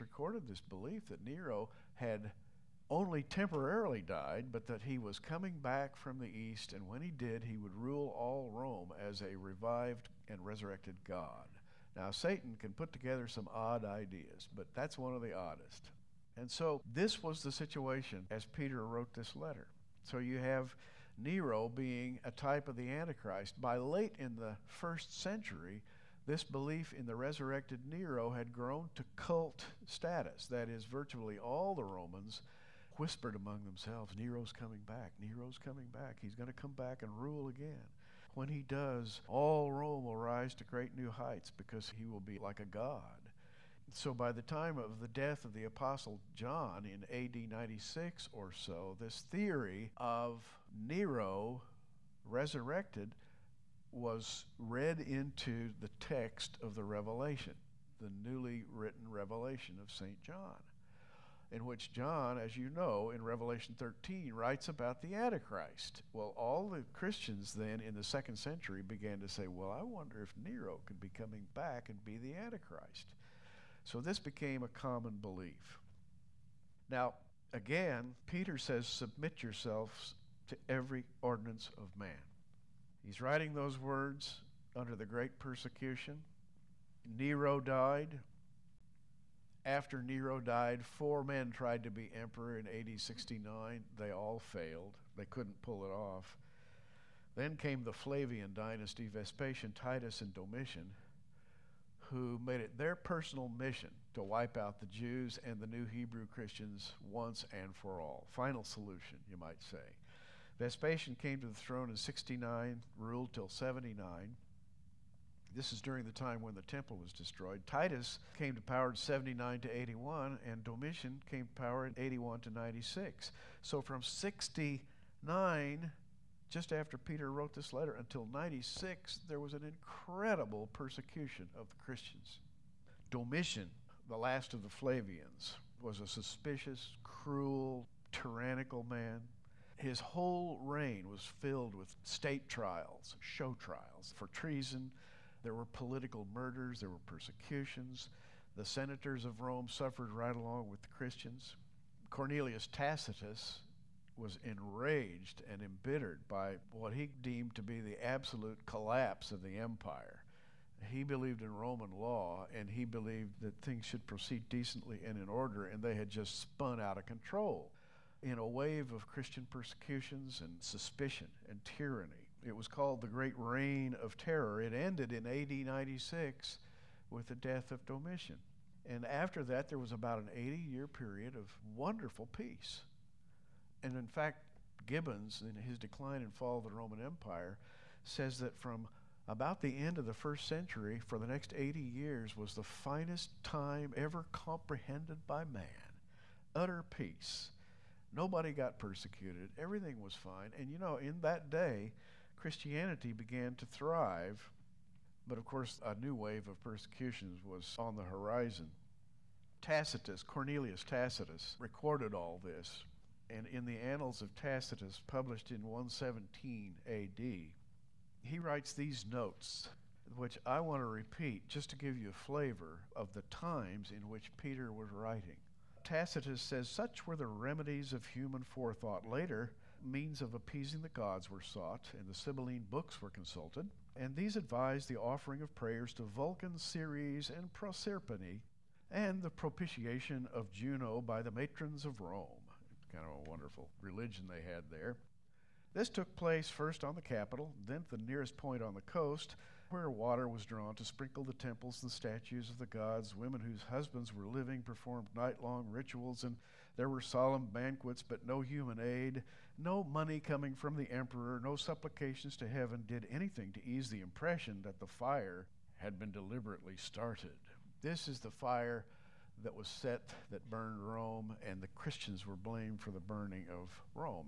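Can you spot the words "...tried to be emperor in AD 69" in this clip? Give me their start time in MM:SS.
01:31.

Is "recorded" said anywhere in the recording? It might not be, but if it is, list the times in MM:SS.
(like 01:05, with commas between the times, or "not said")
00:00, 03:31.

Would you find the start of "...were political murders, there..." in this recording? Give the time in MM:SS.
02:25.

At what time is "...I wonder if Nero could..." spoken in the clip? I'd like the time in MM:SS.
01:09.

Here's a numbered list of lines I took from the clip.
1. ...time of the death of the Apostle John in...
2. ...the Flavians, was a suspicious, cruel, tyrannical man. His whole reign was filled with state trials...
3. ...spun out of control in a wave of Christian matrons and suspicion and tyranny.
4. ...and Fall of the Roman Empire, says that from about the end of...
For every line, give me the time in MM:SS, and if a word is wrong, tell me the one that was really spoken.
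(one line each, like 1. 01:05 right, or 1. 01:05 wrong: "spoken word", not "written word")
1. 00:44 right
2. 02:14 right
3. 02:46 wrong: "persecutions", not "matrons"
4. 03:06 right.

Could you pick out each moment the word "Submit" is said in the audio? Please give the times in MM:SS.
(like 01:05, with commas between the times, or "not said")
01:18.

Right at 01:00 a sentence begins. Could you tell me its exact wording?
John in which John, as you know, in Revelation 13, writes about the Antichrist.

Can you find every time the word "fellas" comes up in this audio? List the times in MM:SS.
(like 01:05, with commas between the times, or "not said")
not said.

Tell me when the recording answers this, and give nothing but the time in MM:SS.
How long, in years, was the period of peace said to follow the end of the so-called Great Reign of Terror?
03:00.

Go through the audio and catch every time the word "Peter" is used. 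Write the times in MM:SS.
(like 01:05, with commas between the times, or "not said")
00:18, 01:18, 02:06, 03:44.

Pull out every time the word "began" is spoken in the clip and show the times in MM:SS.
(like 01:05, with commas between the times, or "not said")
01:08, 03:23.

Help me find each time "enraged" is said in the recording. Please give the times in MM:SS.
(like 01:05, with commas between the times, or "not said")
02:34.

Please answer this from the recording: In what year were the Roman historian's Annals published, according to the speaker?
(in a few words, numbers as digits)
117 AD.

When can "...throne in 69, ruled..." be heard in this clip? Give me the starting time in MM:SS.
01:51.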